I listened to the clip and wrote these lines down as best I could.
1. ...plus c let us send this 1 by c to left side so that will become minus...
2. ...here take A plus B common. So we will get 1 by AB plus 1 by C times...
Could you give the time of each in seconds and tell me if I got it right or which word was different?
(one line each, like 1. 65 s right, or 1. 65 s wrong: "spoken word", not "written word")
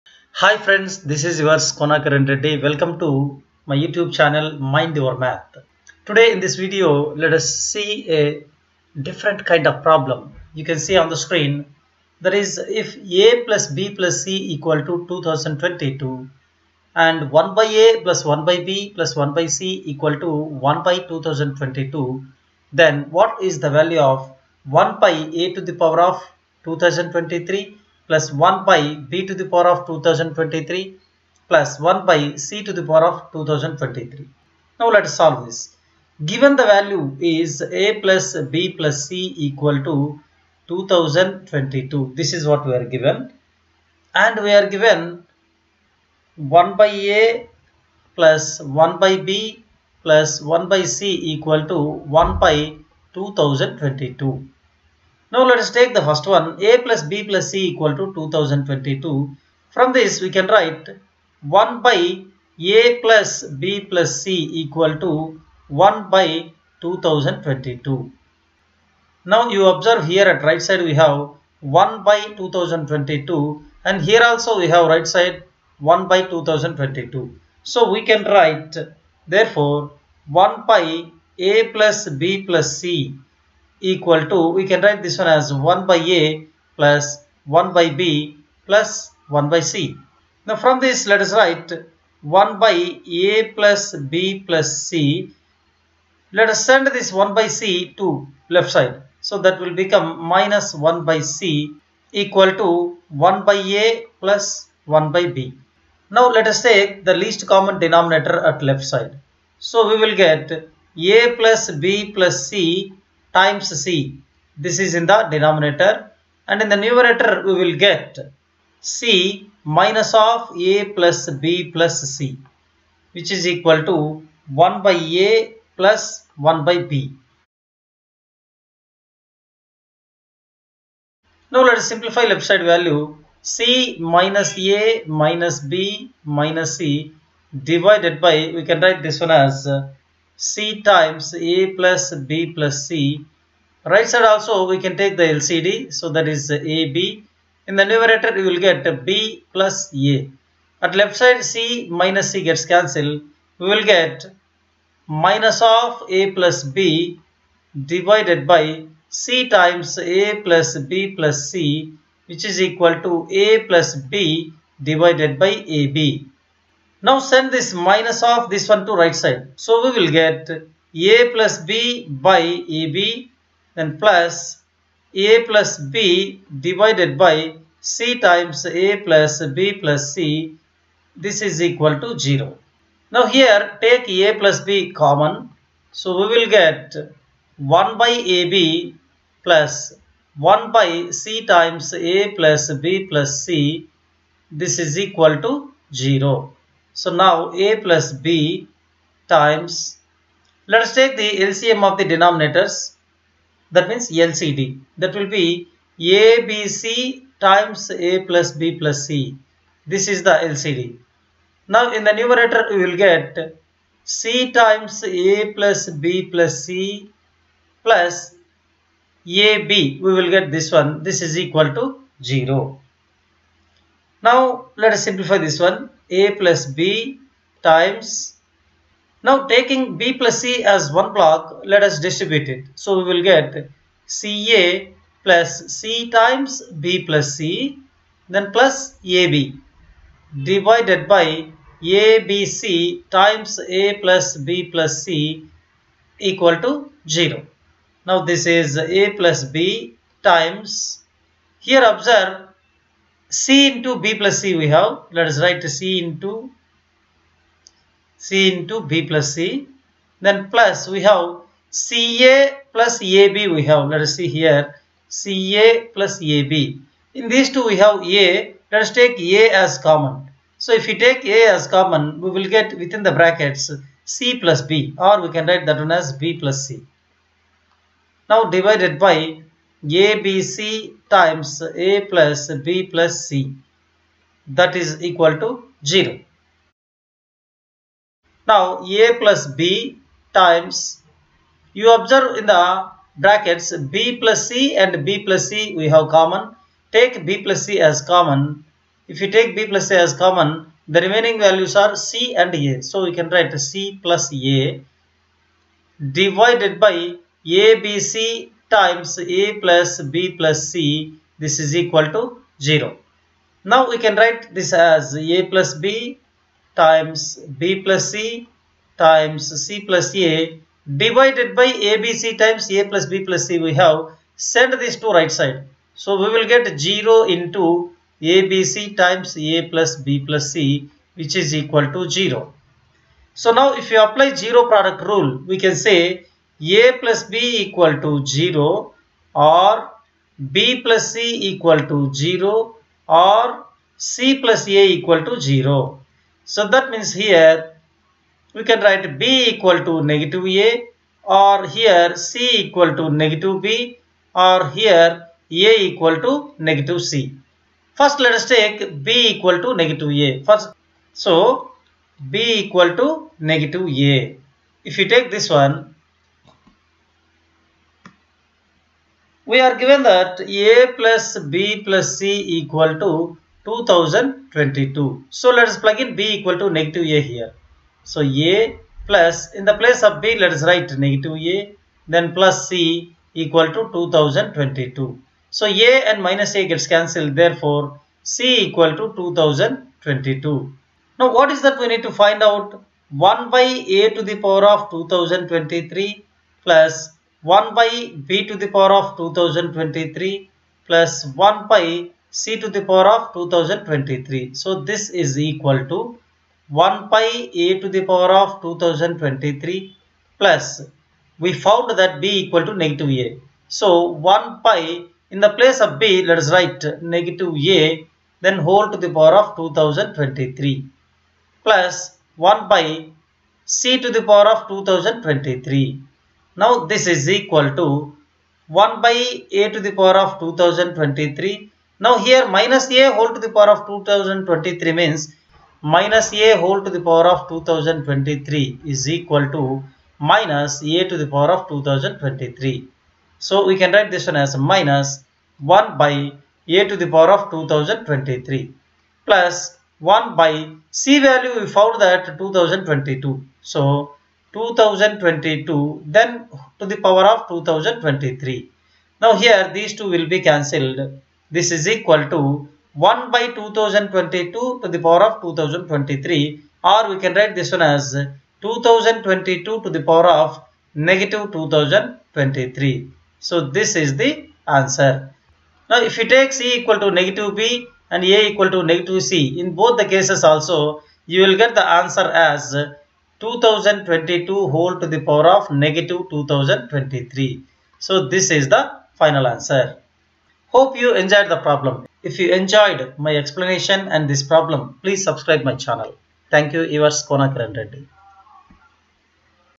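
1. 94 s right
2. 183 s right.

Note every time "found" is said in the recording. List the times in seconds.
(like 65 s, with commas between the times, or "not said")
411 s, 451 s.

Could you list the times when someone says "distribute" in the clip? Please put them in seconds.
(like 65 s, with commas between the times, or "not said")
232 s.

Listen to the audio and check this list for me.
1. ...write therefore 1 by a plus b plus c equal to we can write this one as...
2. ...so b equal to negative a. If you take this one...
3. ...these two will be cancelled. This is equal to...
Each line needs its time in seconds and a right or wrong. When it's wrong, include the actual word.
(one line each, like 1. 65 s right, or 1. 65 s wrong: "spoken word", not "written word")
1. 78 s right
2. 361 s right
3. 459 s right.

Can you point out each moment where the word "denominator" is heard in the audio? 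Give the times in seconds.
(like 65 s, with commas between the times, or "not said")
107 s, 115 s, 202 s.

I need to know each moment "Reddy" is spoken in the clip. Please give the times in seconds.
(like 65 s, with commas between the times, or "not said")
2 s, 497 s.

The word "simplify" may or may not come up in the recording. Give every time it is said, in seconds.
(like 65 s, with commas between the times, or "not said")
131 s, 225 s.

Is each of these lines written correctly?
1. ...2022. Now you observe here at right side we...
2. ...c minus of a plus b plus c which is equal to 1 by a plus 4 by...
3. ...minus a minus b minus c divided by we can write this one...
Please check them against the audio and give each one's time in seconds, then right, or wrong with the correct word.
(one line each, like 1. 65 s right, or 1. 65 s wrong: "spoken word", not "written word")
1. 66 s right
2. 118 s wrong: "1", not "4"
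3. 133 s right.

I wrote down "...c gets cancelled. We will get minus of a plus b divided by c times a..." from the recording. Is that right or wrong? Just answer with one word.
right.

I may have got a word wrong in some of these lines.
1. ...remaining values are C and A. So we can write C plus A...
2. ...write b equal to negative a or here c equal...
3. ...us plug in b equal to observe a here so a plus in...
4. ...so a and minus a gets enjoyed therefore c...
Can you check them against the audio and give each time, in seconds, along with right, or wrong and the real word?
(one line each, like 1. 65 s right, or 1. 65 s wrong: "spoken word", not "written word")
1. 301 s right
2. 348 s right
3. 375 s wrong: "negative", not "observe"
4. 385 s wrong: "cancelled", not "enjoyed".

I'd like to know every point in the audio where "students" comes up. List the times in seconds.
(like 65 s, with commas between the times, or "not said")
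not said.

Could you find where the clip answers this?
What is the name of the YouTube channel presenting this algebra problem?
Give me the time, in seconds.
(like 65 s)
4 s.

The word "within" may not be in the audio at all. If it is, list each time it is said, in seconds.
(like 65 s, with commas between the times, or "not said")
272 s.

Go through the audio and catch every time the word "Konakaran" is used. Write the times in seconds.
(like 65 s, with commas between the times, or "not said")
1 s, 497 s.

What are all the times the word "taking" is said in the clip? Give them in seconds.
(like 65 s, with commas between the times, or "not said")
229 s.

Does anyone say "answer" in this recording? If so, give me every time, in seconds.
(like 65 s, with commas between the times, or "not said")
474 s, 481 s, 489 s.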